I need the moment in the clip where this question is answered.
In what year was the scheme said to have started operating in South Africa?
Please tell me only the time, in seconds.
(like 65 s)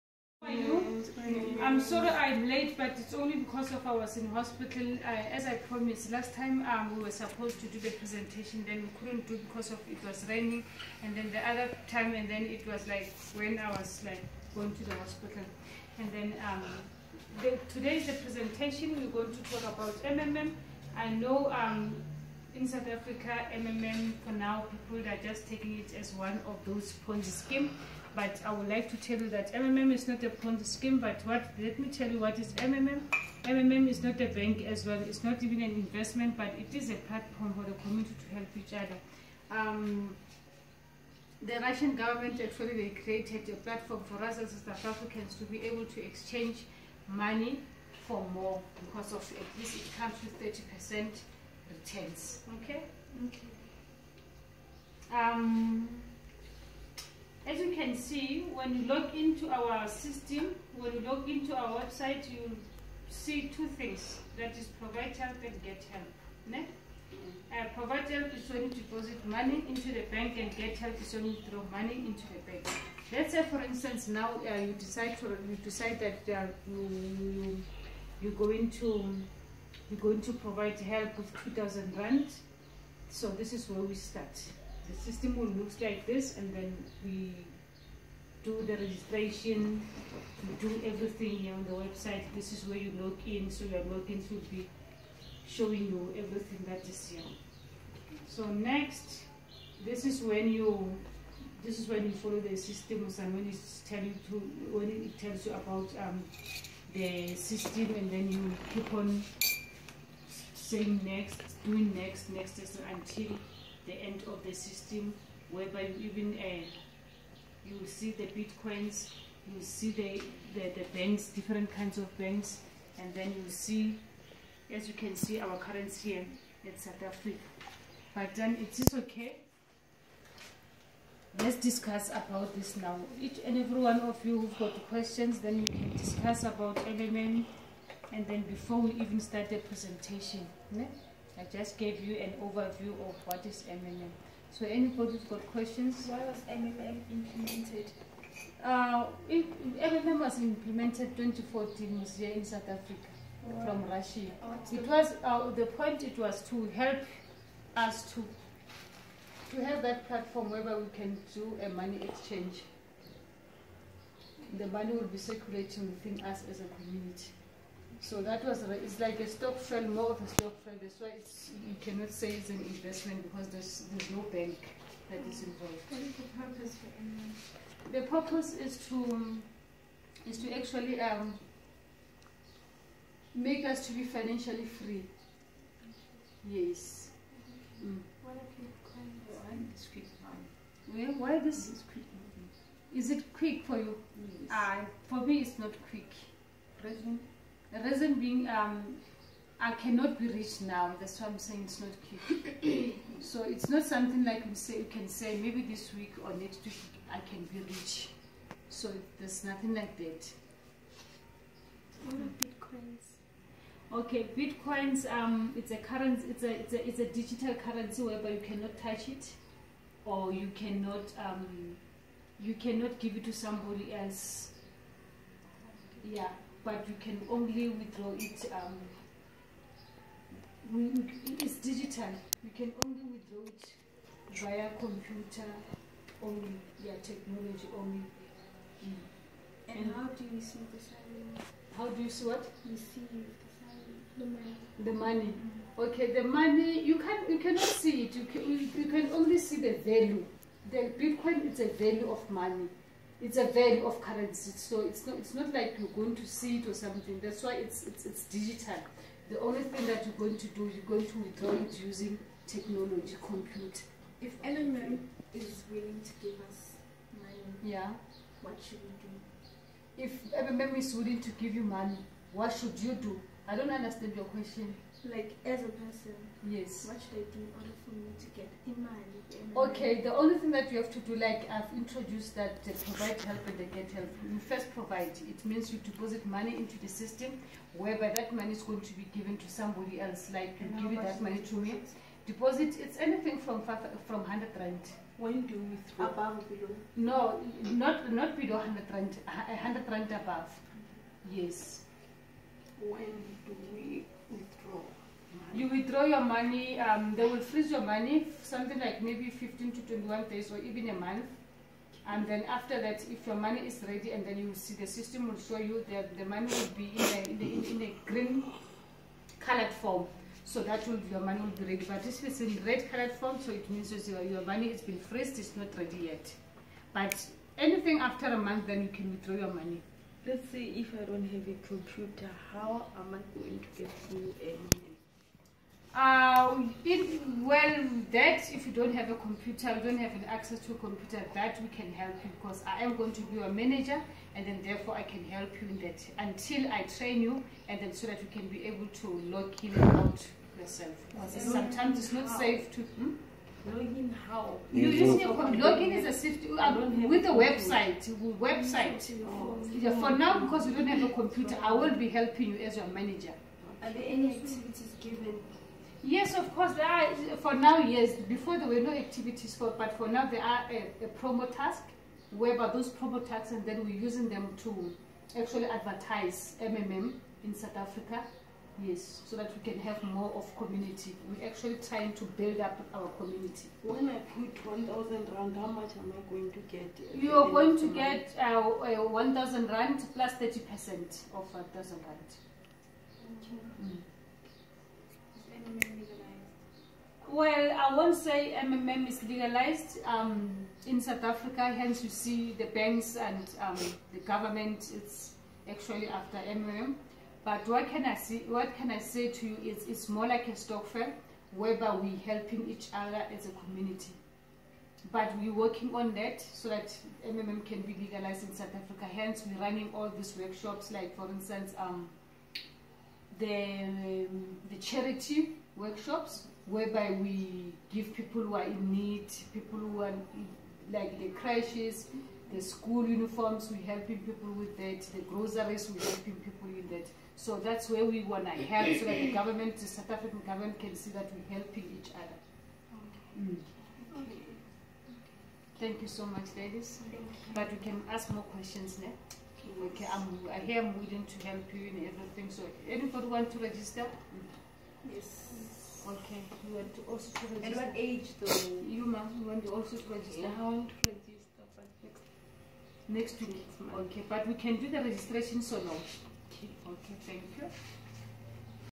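151 s.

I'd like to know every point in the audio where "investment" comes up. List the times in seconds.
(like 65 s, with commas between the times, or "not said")
35 s, 172 s.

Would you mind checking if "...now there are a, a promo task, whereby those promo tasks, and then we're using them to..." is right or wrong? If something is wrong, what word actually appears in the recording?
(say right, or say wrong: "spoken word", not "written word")
right.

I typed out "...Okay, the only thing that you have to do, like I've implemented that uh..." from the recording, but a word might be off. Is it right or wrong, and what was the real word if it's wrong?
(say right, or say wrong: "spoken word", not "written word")
wrong: "introduced", not "implemented".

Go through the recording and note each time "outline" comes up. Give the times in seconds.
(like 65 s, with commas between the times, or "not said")
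not said.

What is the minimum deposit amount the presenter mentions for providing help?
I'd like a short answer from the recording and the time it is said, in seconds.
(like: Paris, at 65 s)
100 rand, at 299 s.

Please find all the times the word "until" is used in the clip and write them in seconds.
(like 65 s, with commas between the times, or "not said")
112 s, 346 s.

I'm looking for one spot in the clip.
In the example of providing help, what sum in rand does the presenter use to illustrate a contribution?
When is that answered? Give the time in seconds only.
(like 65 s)
81 s.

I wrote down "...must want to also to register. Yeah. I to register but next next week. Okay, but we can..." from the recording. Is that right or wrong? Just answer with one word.
right.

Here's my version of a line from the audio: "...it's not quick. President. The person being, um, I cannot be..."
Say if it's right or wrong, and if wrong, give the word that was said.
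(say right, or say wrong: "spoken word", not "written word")
wrong: "reason", not "person".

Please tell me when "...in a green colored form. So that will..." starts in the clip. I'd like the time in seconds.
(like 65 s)
317 s.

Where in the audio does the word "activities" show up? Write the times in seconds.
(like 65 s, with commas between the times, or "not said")
364 s, 368 s.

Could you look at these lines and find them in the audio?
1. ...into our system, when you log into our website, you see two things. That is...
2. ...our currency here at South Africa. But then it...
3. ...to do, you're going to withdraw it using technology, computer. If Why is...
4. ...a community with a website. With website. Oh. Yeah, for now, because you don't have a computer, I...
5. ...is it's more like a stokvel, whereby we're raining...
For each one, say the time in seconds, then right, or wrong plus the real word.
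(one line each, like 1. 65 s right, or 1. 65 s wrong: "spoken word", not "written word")
1. 59 s right
2. 125 s right
3. 260 s wrong: "LMM", not "Why"
4. 356 s wrong: "safety", not "community"
5. 409 s wrong: "helping", not "raining".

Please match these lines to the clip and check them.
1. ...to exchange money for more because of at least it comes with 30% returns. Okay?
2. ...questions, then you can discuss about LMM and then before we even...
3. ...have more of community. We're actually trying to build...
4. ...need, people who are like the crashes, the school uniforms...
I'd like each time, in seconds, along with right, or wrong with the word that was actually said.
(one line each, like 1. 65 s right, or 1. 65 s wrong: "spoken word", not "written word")
1. 45 s right
2. 134 s right
3. 379 s right
4. 428 s right.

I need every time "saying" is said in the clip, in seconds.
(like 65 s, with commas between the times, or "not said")
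110 s, 201 s.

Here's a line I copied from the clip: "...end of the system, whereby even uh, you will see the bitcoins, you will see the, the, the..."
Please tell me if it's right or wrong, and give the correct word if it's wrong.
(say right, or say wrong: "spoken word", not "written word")
right.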